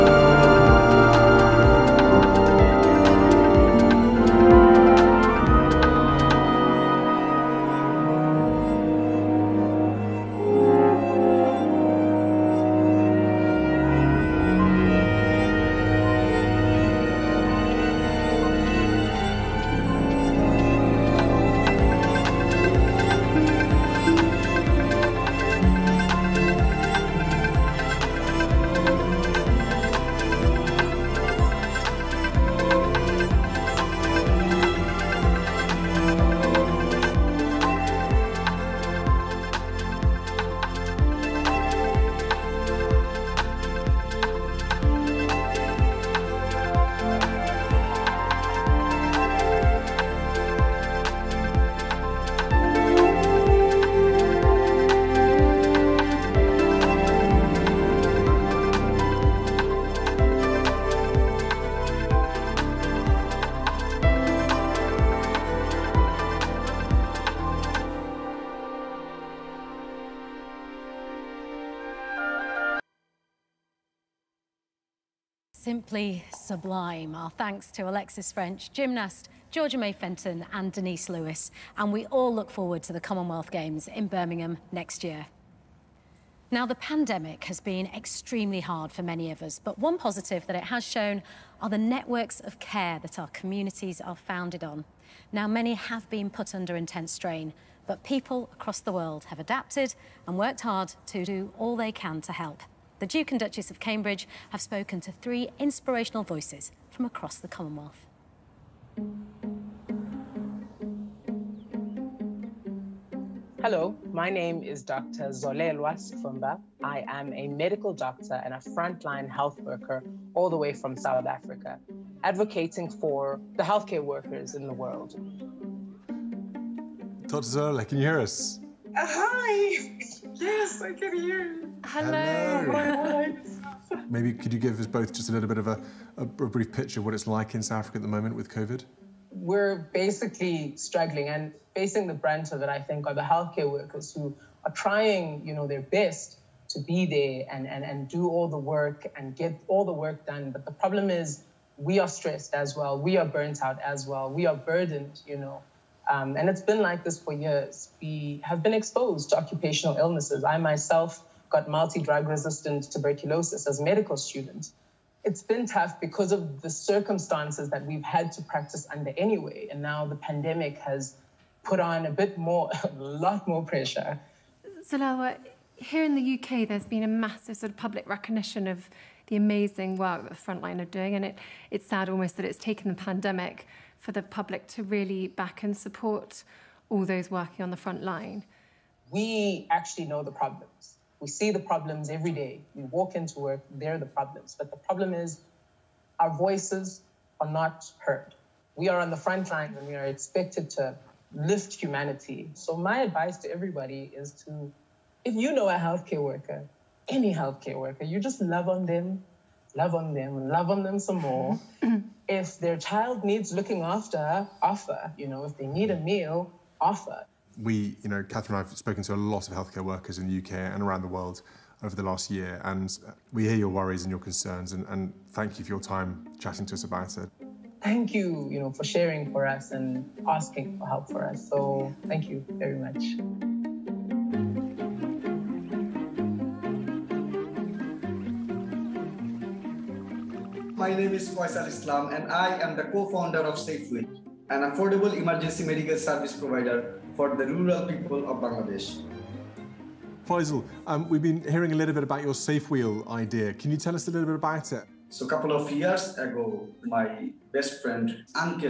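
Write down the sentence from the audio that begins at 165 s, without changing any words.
It's been tough because of the circumstances that we've had to practice under anyway.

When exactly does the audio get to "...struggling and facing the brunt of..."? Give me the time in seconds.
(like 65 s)
140 s.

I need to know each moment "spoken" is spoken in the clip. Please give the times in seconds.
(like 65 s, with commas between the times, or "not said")
104 s, 218 s.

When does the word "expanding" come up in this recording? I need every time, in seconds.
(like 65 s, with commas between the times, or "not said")
not said.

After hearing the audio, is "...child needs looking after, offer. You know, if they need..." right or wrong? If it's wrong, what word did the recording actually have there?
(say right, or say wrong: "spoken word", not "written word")
right.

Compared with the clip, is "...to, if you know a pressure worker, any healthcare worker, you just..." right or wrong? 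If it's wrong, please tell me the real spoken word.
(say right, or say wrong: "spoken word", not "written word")
wrong: "healthcare", not "pressure".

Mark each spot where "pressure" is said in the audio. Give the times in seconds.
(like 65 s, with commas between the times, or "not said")
173 s.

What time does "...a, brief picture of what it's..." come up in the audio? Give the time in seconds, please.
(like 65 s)
136 s.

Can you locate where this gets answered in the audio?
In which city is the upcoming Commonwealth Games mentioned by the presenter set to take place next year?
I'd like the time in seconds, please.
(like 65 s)
84 s.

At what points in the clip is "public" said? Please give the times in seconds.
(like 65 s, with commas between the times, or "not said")
177 s, 184 s.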